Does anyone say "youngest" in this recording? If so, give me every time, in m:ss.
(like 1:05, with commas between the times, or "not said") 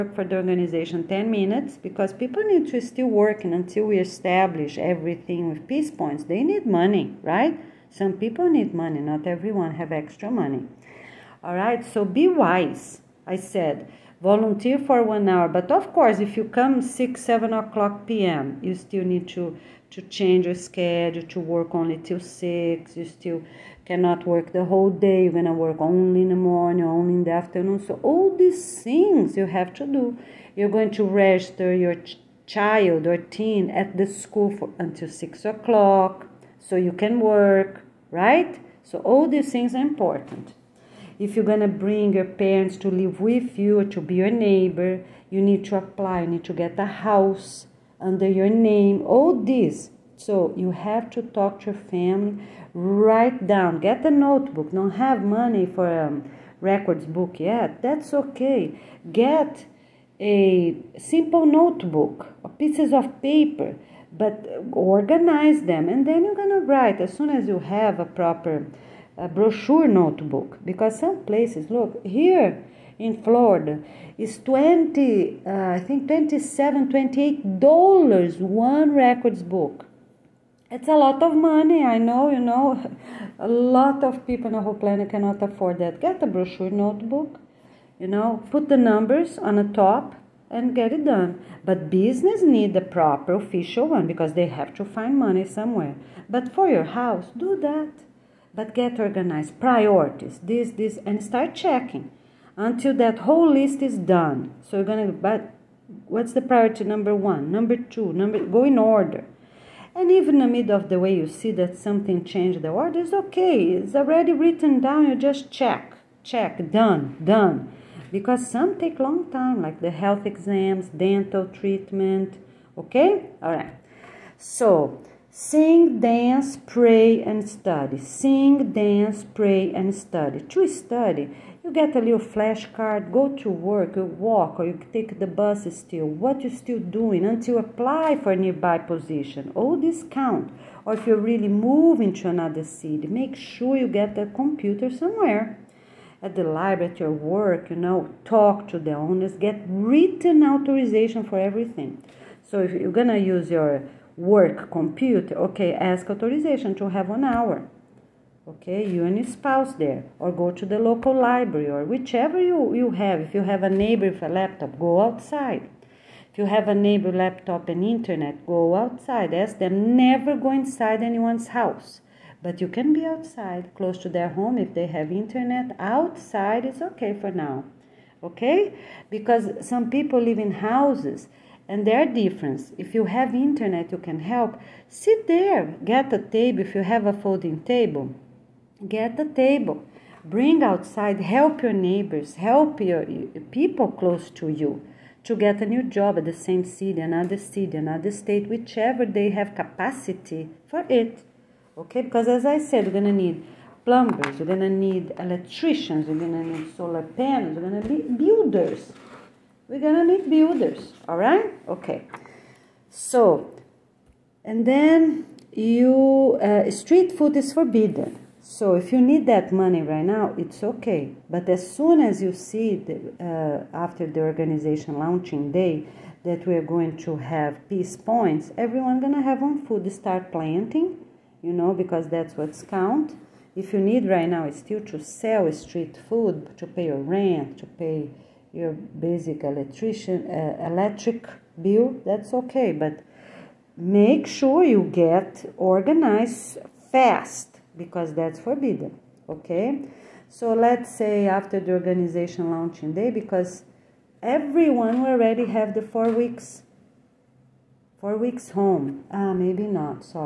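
not said.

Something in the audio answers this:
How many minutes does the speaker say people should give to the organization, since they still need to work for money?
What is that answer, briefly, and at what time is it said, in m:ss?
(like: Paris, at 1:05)
10, at 0:01.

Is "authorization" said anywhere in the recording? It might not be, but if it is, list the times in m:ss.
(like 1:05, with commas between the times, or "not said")
2:30, 2:36.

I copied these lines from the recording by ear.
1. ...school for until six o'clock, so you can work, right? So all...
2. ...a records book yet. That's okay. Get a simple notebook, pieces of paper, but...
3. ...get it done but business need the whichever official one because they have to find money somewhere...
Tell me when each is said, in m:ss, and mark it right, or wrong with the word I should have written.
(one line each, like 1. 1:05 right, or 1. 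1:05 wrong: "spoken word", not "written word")
1. 0:34 right
2. 0:55 right
3. 1:30 wrong: "proper", not "whichever".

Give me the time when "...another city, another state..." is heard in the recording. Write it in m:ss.
3:17.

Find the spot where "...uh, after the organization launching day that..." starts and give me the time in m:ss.
3:43.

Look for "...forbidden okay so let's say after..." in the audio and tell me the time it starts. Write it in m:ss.
4:08.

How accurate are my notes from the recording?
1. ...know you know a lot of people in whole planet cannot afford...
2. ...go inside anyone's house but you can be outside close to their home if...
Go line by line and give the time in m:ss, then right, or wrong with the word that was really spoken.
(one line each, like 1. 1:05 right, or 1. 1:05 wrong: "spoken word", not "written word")
1. 1:21 right
2. 2:50 right.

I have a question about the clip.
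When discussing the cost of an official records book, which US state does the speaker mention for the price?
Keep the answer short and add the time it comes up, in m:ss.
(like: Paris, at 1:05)
Florida, at 1:13.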